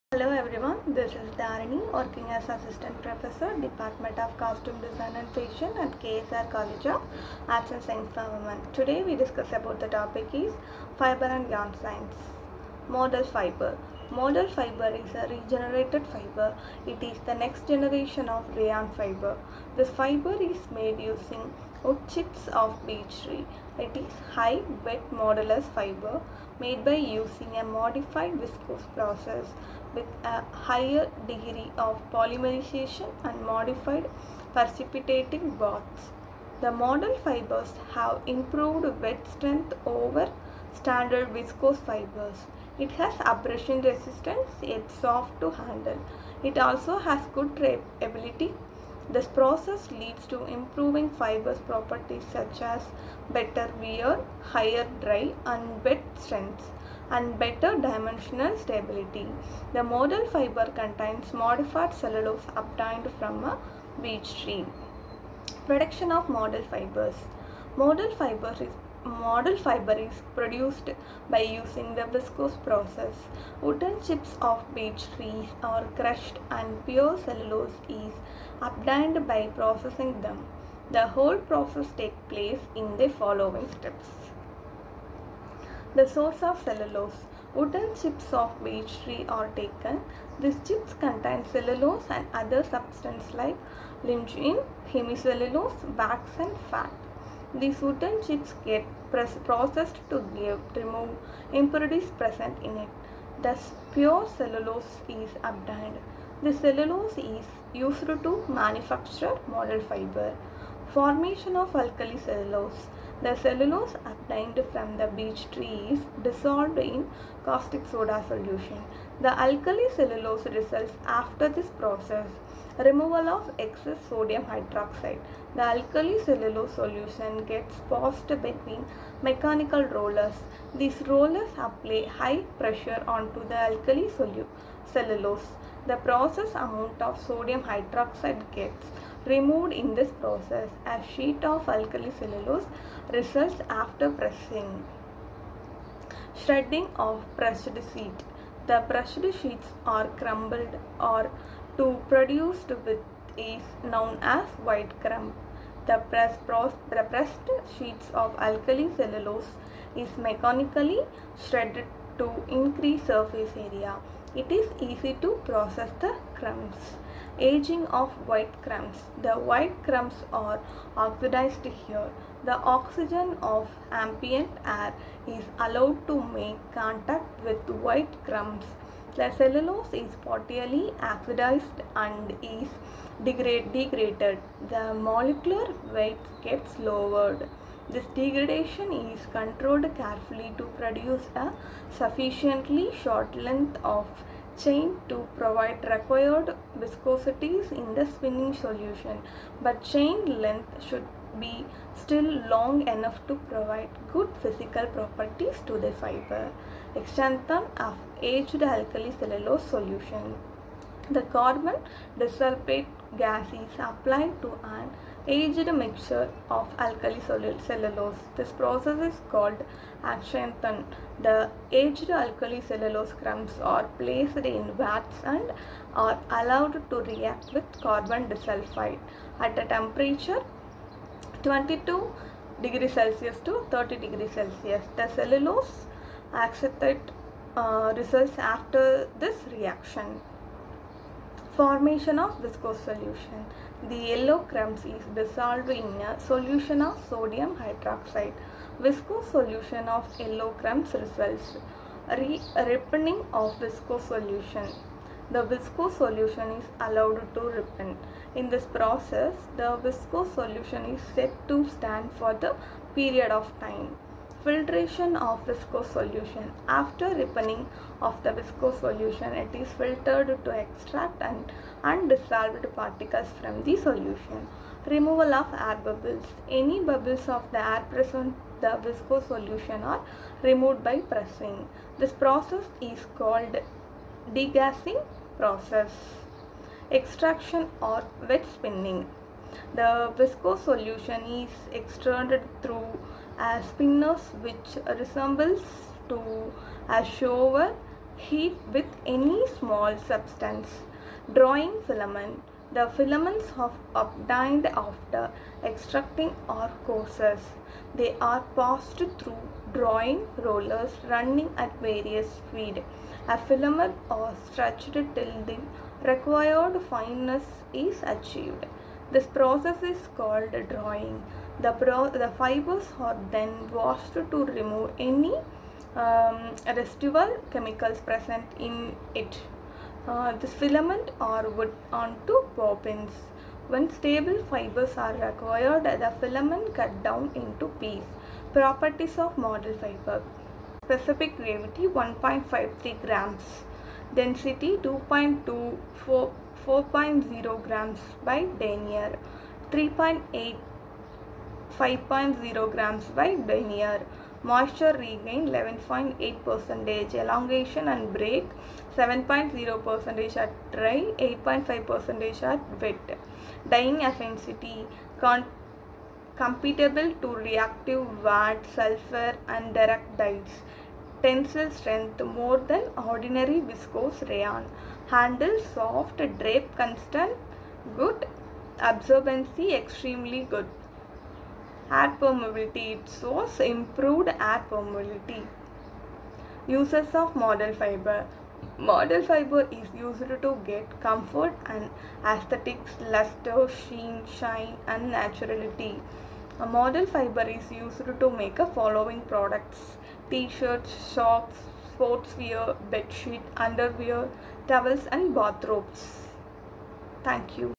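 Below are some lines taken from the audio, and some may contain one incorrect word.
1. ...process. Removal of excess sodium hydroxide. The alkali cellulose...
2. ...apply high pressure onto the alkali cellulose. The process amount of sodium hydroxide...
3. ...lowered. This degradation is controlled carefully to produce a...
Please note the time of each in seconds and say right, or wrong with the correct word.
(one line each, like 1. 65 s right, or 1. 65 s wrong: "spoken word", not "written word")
1. 121 s right
2. 131 s right
3. 186 s right.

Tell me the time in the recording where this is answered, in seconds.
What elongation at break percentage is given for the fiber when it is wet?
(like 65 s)
361 s.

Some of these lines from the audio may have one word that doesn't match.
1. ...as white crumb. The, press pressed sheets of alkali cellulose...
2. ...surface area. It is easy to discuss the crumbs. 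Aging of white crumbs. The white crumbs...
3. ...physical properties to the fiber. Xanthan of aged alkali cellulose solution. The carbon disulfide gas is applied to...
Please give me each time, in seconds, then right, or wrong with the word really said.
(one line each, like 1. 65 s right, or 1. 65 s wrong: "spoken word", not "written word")
1. 154 s right
2. 163 s wrong: "process", not "discuss"
3. 204 s right.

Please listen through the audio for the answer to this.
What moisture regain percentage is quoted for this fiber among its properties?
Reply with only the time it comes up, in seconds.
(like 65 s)
355 s.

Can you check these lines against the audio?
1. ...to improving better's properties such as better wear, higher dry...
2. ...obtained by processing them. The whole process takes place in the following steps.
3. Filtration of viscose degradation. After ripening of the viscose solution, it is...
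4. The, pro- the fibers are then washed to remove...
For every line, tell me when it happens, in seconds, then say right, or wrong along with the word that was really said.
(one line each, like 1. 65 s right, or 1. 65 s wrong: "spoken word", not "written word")
1. 50 s wrong: "fiber", not "better"
2. 78 s right
3. 264 s wrong: "solution", not "degradation"
4. 321 s right.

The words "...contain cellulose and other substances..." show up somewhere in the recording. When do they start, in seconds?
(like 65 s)
90 s.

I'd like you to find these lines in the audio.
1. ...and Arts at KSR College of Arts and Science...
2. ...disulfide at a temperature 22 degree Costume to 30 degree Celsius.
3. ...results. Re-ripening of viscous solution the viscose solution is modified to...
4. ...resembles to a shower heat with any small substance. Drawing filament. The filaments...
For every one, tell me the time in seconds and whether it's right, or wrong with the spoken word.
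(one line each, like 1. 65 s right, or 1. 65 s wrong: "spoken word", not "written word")
1. 5 s wrong: "Fashion", not "Arts"
2. 228 s wrong: "Celsius", not "Costume"
3. 250 s wrong: "allowed", not "modified"
4. 294 s right.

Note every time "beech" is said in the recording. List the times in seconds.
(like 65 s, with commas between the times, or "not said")
22 s, 64 s, 74 s, 88 s, 115 s.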